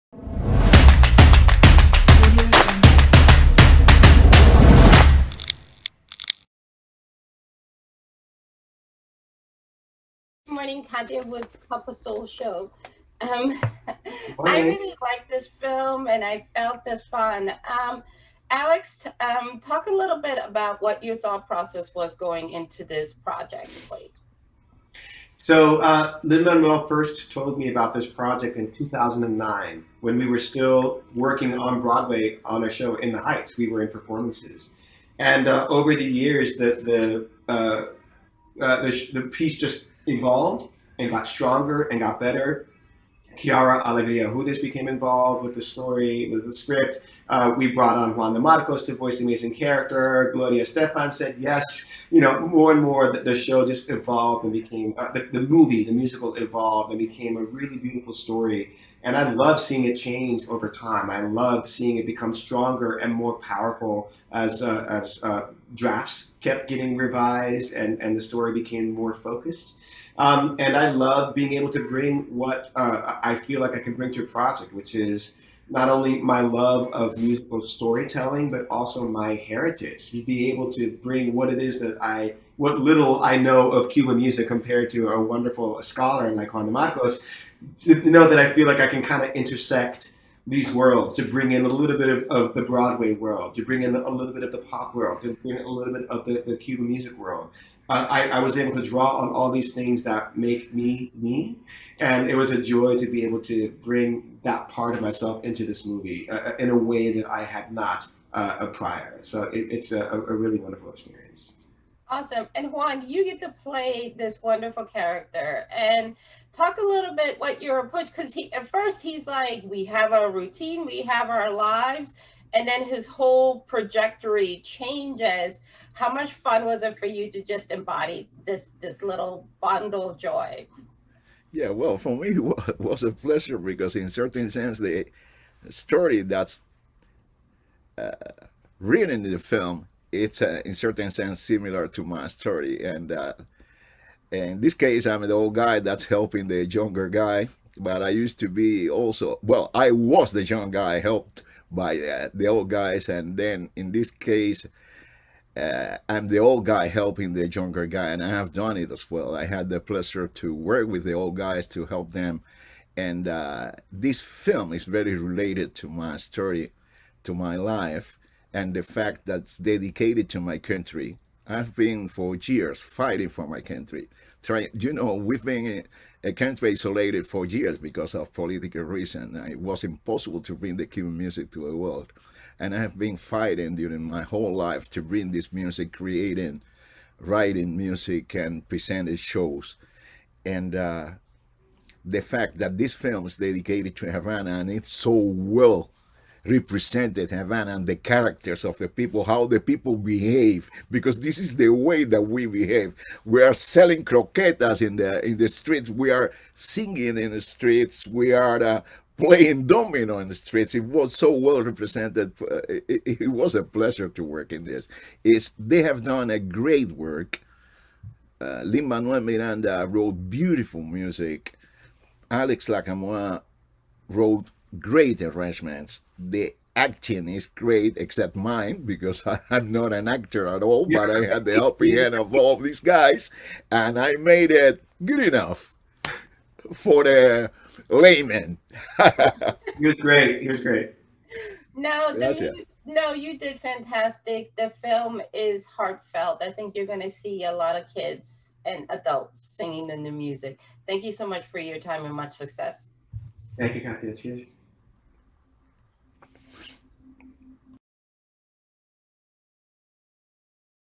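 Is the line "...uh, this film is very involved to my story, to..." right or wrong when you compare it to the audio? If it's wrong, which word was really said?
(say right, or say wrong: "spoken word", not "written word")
wrong: "related", not "involved".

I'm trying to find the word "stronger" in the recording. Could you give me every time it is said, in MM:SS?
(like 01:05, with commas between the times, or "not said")
00:41, 01:02.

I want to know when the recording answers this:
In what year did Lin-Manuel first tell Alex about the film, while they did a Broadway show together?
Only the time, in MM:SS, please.
00:28.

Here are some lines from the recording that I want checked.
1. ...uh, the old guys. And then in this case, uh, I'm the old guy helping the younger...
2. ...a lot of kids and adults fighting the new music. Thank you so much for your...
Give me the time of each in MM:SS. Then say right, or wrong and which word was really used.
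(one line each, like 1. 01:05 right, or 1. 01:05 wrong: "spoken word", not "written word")
1. 02:31 right
2. 04:07 wrong: "singing", not "fighting".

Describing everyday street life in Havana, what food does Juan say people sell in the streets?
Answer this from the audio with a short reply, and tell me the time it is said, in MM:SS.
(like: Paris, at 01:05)
Croquetas, at 03:24.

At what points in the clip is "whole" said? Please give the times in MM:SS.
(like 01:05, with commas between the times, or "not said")
02:03, 03:04.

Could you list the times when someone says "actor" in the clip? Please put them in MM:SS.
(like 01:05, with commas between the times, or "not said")
03:50.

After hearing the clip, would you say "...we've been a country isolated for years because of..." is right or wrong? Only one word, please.
right.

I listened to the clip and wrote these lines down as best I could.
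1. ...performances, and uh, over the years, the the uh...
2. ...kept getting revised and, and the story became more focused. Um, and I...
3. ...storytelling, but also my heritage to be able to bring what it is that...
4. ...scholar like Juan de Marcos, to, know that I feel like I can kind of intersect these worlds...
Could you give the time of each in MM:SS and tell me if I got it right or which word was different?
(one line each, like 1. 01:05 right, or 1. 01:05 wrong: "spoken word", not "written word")
1. 00:33 right
2. 01:06 right
3. 01:17 right
4. 01:25 right.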